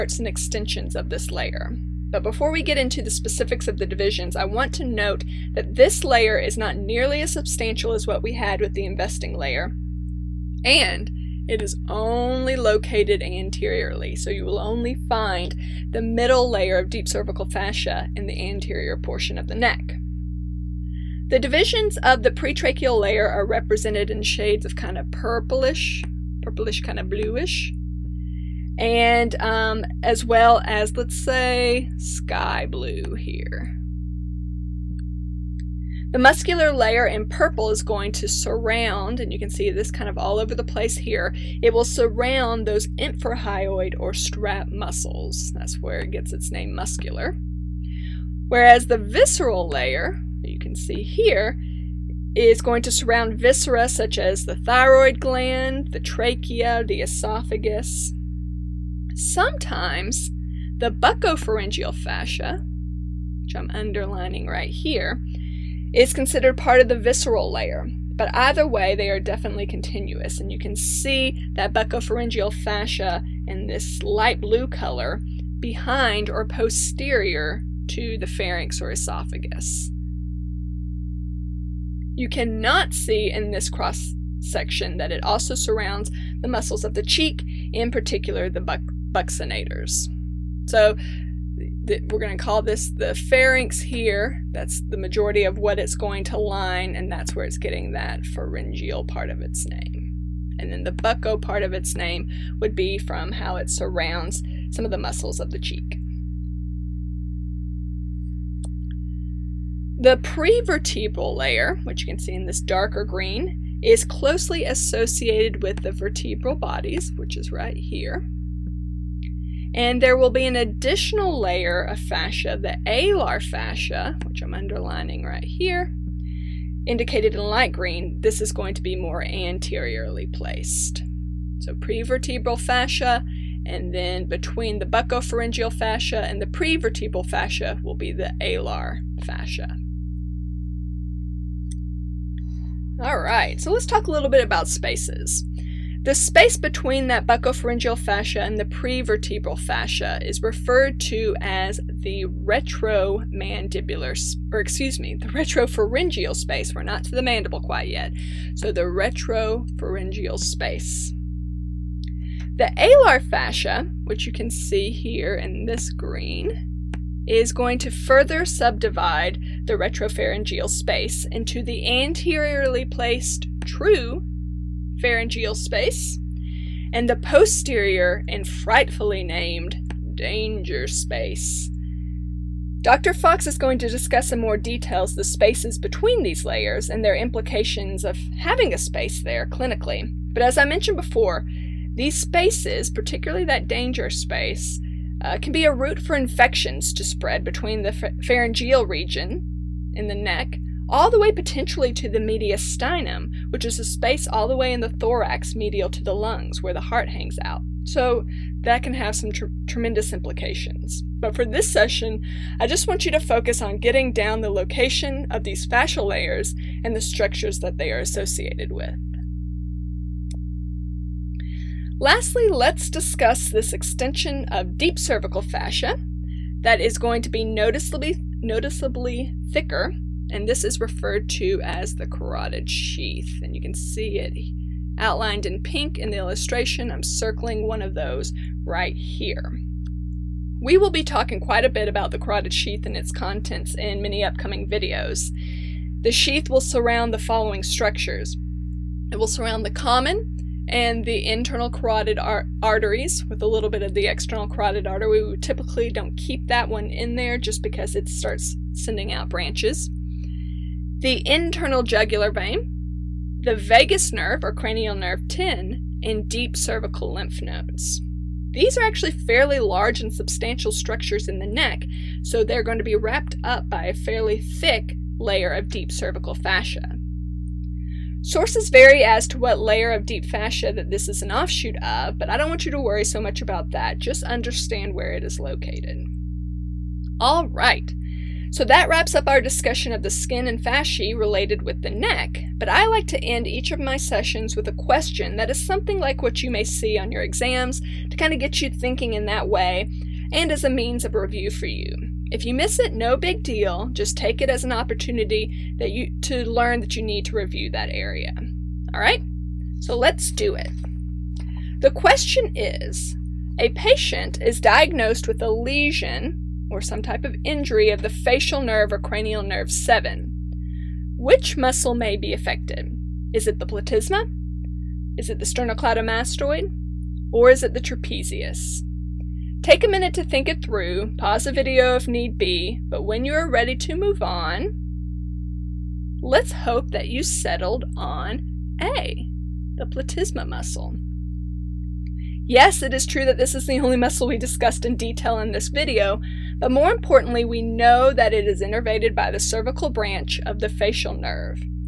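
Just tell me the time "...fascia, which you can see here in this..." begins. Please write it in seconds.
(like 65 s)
163 s.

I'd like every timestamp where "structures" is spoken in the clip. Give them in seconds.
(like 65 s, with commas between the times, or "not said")
217 s, 247 s, 270 s.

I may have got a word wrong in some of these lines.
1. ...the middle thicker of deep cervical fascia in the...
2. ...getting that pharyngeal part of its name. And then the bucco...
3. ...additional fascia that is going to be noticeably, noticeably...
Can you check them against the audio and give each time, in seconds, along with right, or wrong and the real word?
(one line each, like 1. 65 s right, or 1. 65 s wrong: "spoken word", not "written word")
1. 15 s wrong: "layer", not "thicker"
2. 97 s right
3. 224 s wrong: "cervical", not "additional".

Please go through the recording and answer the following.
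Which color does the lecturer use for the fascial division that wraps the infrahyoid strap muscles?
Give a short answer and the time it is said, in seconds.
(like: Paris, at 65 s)
Purple, at 37 s.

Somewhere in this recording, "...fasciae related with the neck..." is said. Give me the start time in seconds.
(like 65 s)
290 s.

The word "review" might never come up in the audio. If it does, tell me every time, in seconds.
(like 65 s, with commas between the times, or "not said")
301 s, 307 s.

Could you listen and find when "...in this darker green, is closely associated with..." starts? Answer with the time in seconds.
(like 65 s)
112 s.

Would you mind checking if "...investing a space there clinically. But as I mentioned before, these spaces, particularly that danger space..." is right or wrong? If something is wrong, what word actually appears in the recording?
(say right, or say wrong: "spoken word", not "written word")
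wrong: "having", not "investing".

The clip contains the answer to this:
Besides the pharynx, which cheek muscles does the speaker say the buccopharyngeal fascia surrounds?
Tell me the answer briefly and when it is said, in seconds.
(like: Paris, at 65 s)
Buccinators, at 89 s.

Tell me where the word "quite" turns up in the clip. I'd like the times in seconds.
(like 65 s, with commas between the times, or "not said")
157 s, 241 s.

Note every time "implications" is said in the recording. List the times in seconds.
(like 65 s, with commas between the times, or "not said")
187 s, 210 s.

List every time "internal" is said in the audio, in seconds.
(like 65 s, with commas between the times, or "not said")
251 s, 261 s.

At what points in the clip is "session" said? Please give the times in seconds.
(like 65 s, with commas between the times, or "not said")
211 s, 293 s.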